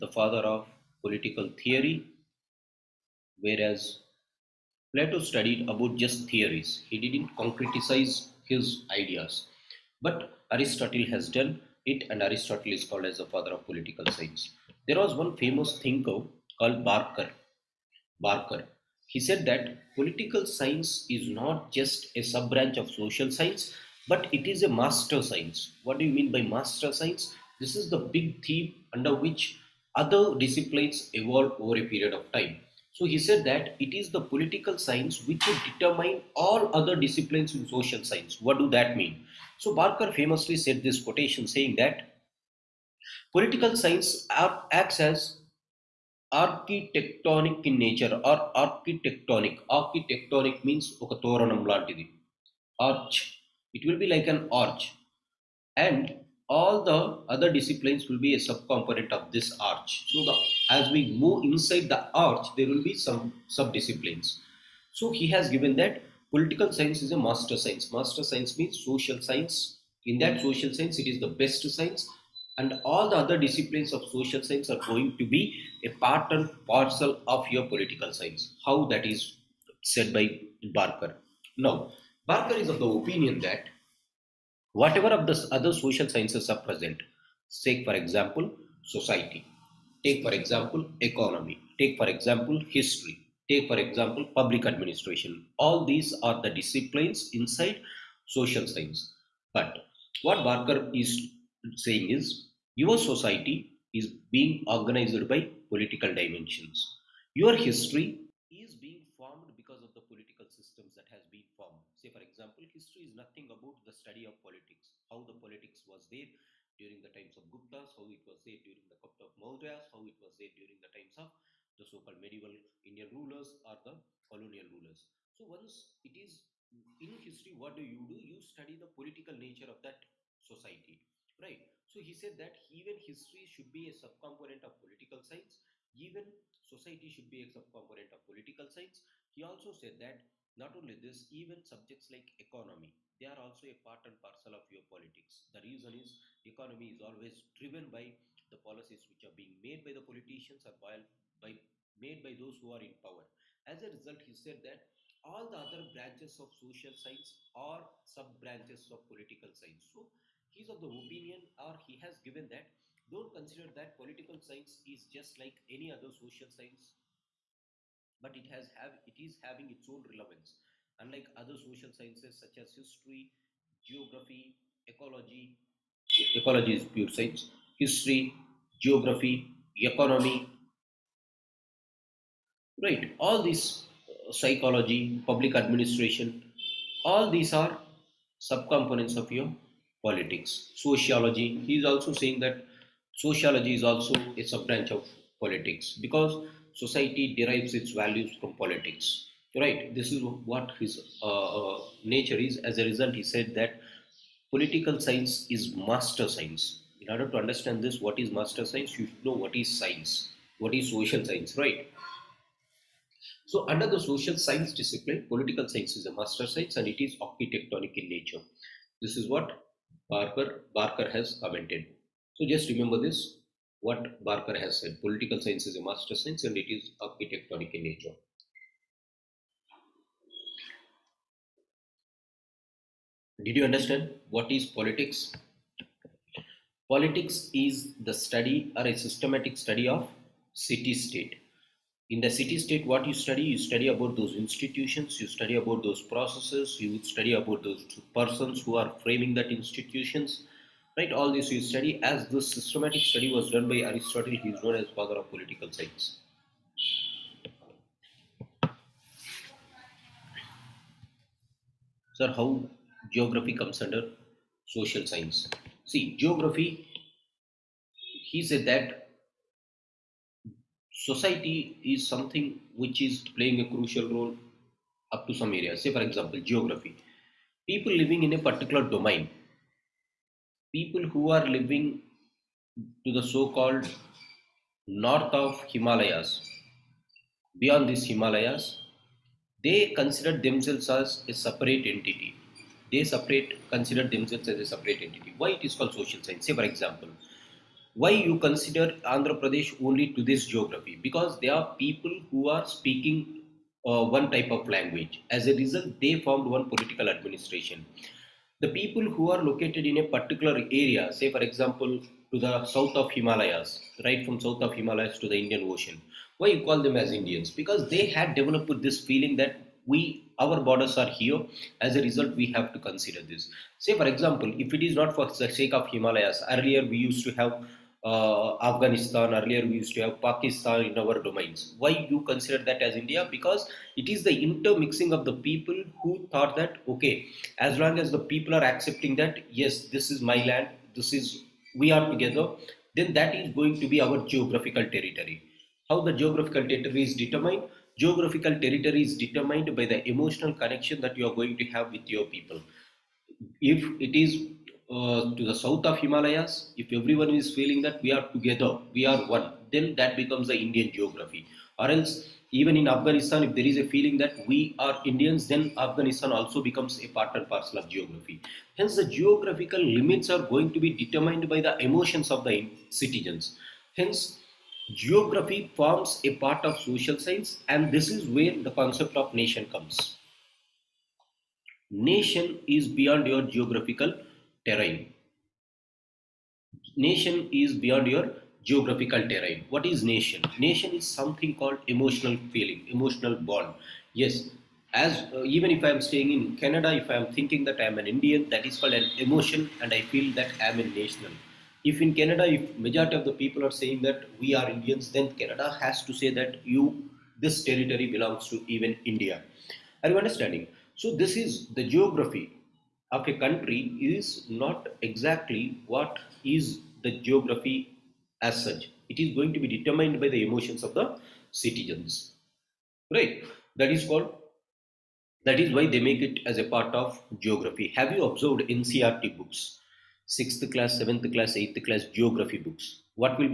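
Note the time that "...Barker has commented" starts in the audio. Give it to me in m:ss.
3:40.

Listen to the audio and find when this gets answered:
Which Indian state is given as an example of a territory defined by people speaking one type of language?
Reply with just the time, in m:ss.
4:59.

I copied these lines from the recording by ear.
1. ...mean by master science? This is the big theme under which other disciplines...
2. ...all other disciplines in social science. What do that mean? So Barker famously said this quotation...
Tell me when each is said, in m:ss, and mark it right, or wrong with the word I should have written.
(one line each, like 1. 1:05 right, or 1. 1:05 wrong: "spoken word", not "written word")
1. 0:26 right
2. 0:36 right.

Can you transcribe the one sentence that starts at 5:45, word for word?
How the geographical territory is determined?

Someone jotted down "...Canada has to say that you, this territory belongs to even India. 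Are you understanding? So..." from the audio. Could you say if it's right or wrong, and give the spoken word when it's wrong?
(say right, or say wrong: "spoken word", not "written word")
right.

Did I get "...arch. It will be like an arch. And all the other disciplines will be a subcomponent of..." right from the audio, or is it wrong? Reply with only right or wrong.
right.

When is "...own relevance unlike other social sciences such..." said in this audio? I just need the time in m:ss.
2:49.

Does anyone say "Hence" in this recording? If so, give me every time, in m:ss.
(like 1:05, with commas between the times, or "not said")
6:08, 6:13.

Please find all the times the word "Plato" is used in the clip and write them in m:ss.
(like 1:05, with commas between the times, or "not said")
0:04.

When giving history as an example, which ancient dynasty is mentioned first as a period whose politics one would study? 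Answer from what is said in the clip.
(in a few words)
Guptas.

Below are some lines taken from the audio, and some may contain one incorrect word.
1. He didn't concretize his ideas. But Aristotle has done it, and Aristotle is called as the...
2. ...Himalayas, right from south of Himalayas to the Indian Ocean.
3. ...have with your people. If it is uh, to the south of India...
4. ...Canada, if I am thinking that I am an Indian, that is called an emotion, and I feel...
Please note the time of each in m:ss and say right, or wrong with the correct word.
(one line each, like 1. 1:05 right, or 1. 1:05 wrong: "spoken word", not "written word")
1. 0:06 right
2. 5:13 right
3. 5:51 wrong: "Himalayas", not "India"
4. 6:36 right.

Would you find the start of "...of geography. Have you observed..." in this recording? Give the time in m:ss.
7:06.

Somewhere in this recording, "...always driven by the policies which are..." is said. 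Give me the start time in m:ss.
2:27.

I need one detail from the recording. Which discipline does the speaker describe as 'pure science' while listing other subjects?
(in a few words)
Ecology.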